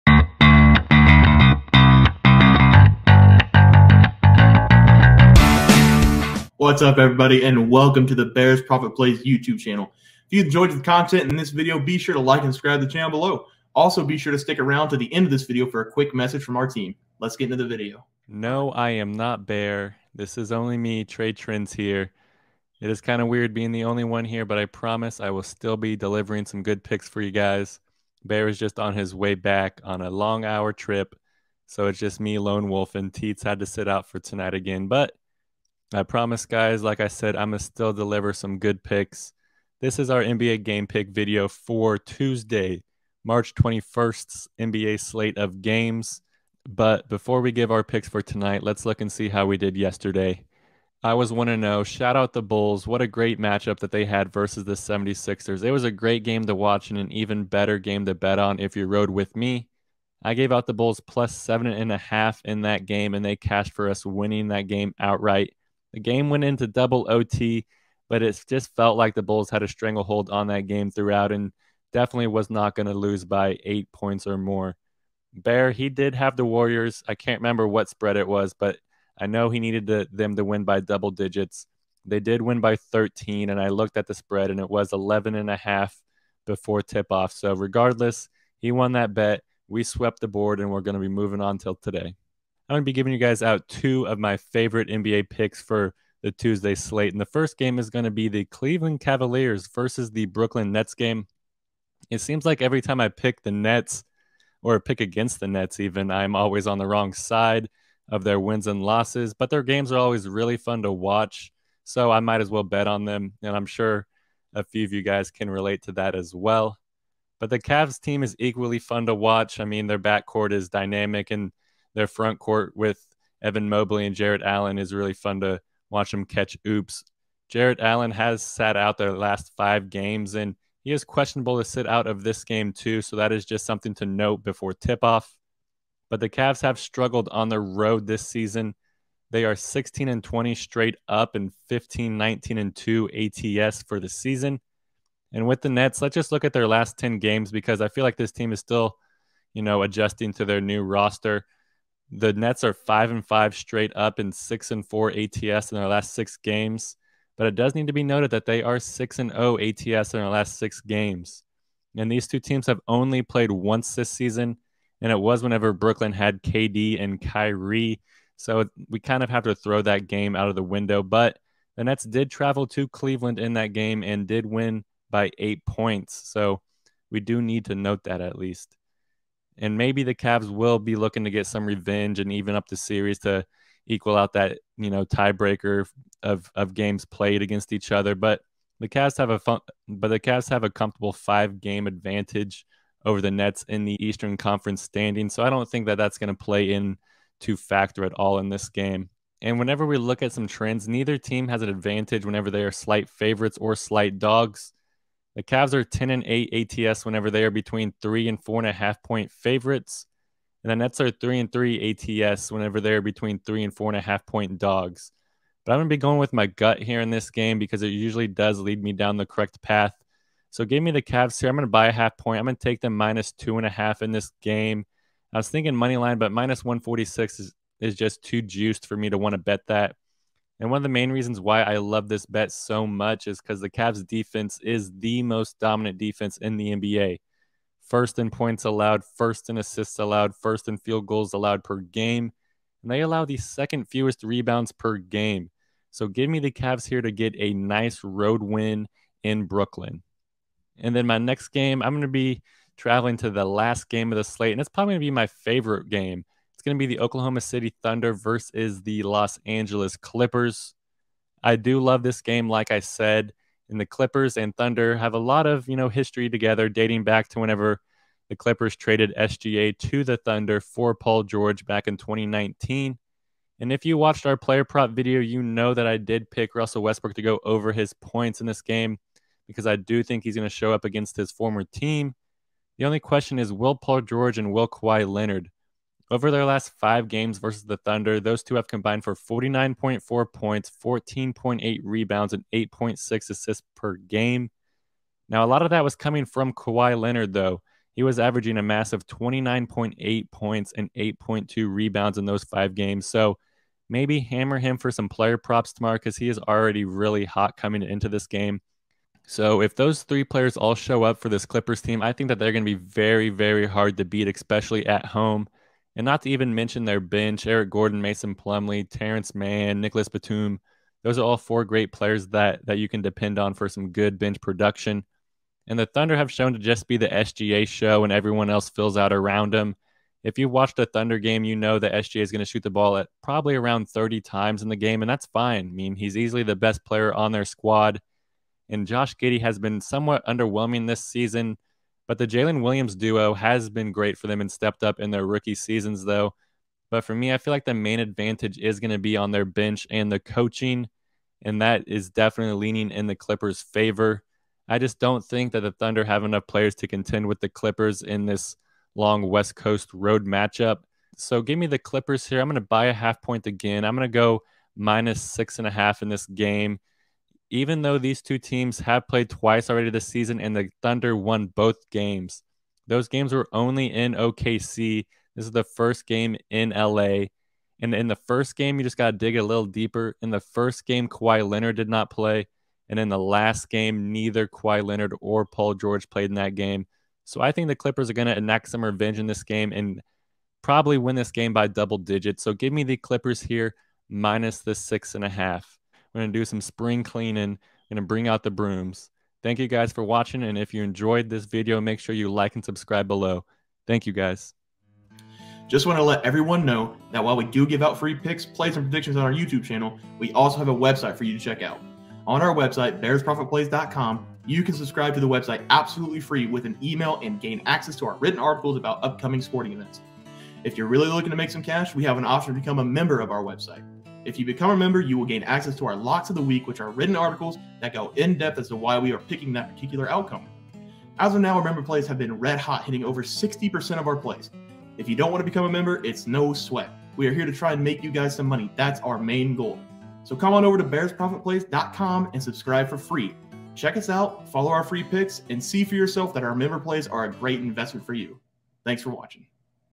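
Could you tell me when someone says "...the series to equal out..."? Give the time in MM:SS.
03:02.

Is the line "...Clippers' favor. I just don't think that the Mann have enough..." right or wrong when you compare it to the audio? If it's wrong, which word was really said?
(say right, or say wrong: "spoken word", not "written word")
wrong: "Thunder", not "Mann".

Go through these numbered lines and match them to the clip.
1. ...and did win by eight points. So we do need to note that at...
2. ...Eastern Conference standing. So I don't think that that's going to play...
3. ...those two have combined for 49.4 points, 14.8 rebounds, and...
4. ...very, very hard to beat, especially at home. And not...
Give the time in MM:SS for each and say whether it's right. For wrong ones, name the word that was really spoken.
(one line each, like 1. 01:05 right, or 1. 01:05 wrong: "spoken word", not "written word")
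1. 02:54 right
2. 03:14 right
3. 04:48 right
4. 05:12 right.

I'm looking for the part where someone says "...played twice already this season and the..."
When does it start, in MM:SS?
06:09.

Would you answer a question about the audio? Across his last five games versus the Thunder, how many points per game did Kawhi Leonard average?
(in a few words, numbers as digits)
29.8.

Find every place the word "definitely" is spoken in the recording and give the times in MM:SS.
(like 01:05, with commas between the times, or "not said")
01:11, 05:52.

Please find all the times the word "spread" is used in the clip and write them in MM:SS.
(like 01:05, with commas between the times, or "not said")
01:17, 01:24.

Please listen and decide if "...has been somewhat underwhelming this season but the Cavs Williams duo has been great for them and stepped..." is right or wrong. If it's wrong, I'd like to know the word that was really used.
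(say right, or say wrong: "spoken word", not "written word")
wrong: "Jalen", not "Cavs".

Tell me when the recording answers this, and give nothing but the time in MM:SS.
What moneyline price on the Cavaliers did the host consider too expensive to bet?
03:46.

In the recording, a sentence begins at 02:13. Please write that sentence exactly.
So that is just something to note before tip off.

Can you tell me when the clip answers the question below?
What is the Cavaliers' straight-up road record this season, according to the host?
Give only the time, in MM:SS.
02:19.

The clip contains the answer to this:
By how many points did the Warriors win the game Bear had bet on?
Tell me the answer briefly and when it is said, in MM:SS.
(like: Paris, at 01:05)
13, at 01:22.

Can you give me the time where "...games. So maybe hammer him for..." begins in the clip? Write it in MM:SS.
05:02.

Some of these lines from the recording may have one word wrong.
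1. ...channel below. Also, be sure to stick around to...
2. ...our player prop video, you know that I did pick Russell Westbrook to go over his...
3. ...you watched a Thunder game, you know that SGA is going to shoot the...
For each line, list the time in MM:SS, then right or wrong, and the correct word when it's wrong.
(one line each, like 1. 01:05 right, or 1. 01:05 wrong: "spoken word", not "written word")
1. 00:12 right
2. 04:34 right
3. 05:30 right.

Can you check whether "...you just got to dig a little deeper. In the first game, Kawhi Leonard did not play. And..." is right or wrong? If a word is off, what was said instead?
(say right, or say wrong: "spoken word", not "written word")
right.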